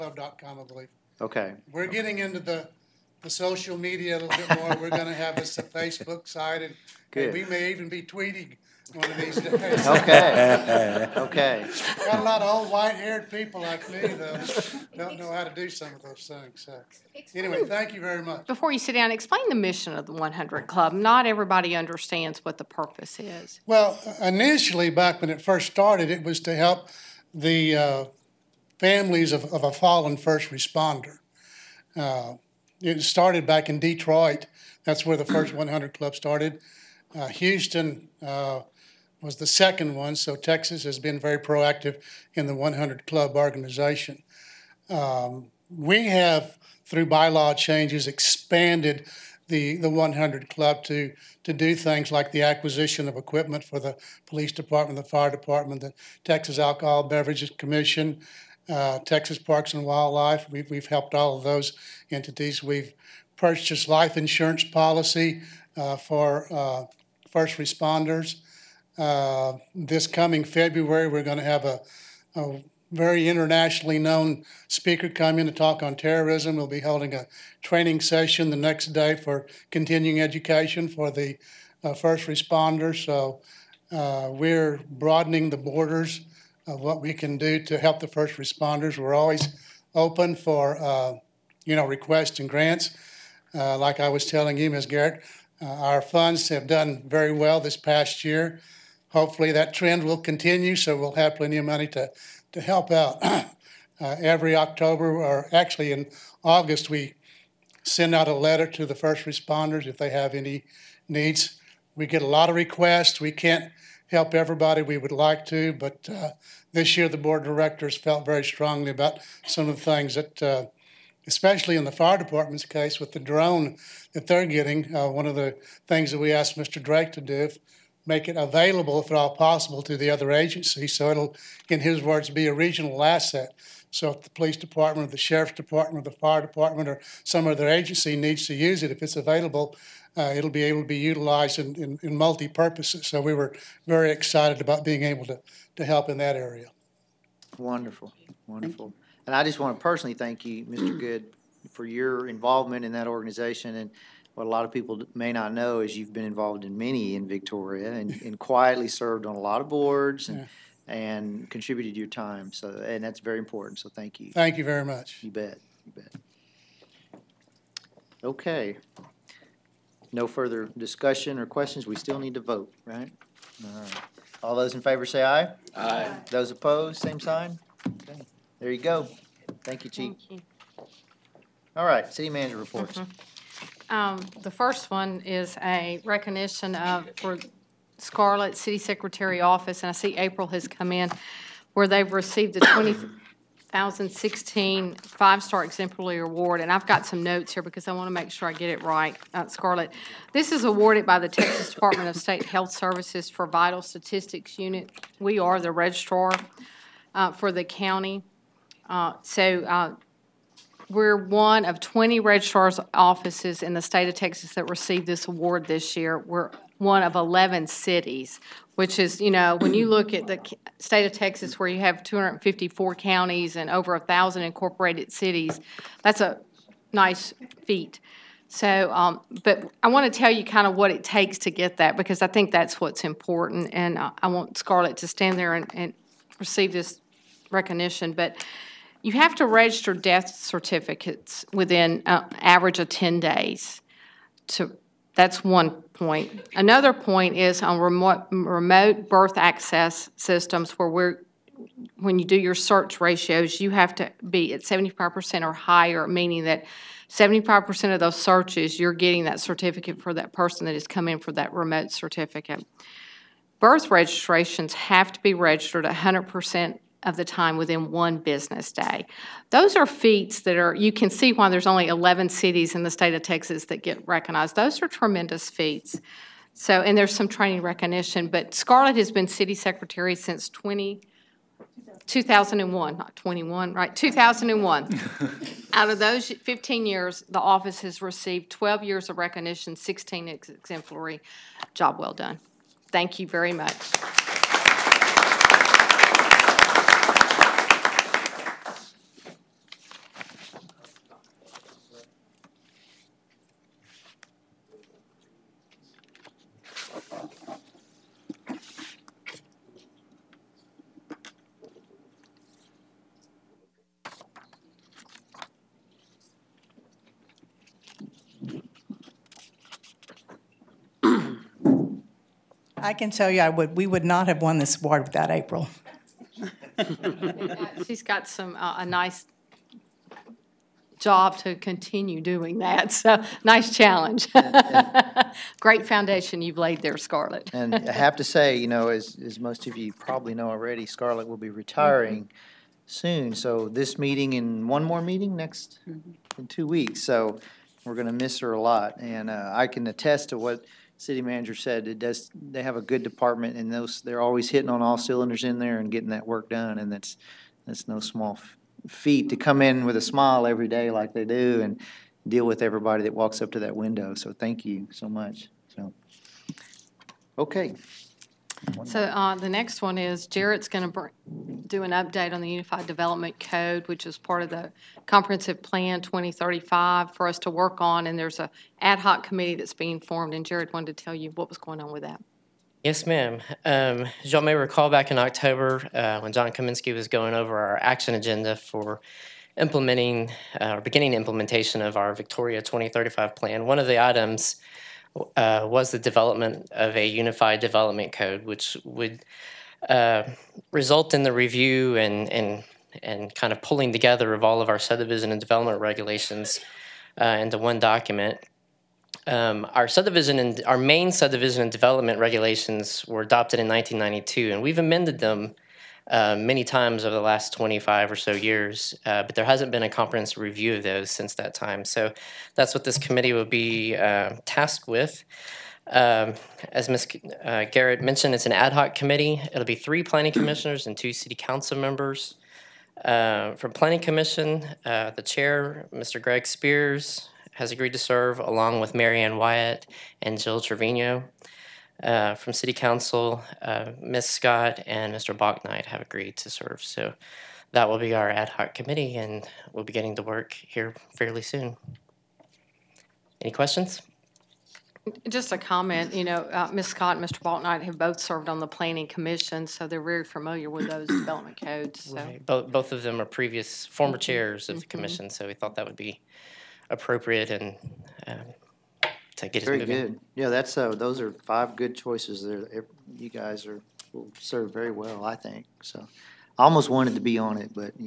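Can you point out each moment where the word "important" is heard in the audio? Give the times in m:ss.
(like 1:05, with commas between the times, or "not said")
2:43, 3:53.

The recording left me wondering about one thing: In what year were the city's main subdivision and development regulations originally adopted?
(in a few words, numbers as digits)
1992.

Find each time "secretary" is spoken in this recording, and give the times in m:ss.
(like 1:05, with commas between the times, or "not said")
3:08, 4:39.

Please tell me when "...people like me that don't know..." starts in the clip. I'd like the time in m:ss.
0:13.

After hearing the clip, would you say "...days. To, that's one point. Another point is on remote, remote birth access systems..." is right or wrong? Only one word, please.
right.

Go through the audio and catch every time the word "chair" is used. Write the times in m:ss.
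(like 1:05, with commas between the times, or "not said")
7:15, 7:44.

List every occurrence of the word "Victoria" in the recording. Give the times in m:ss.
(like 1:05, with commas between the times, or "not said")
2:37, 6:32.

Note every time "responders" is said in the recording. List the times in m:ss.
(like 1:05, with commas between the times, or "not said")
0:30, 1:07, 1:22, 1:28, 1:49.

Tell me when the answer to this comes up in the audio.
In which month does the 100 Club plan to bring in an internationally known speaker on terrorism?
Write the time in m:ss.
1:10.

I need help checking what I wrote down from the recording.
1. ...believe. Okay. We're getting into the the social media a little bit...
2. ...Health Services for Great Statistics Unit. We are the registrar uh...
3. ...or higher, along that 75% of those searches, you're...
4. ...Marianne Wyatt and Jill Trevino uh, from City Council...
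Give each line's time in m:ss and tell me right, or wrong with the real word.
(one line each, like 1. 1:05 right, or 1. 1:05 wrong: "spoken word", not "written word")
1. 0:00 right
2. 3:22 wrong: "Vital", not "Great"
3. 4:15 wrong: "meaning", not "along"
4. 7:18 right.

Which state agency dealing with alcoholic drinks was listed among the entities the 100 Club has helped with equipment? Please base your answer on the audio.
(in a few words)
Texas Alcohol Beverages Commission.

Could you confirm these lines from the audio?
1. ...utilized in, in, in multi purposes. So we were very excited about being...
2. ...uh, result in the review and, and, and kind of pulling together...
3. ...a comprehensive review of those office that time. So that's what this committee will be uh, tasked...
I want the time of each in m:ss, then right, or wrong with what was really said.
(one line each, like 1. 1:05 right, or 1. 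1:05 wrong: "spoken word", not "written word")
1. 2:20 right
2. 6:39 right
3. 6:59 wrong: "since", not "office".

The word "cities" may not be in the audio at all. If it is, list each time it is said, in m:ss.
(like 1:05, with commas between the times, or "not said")
3:37, 3:45, 4:32.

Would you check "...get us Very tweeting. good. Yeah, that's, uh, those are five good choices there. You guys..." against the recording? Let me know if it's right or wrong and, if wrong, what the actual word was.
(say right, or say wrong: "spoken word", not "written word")
wrong: "moving", not "tweeting".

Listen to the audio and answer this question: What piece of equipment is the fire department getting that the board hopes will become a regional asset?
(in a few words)
drone.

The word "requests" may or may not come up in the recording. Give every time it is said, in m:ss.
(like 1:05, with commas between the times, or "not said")
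1:31, 1:52.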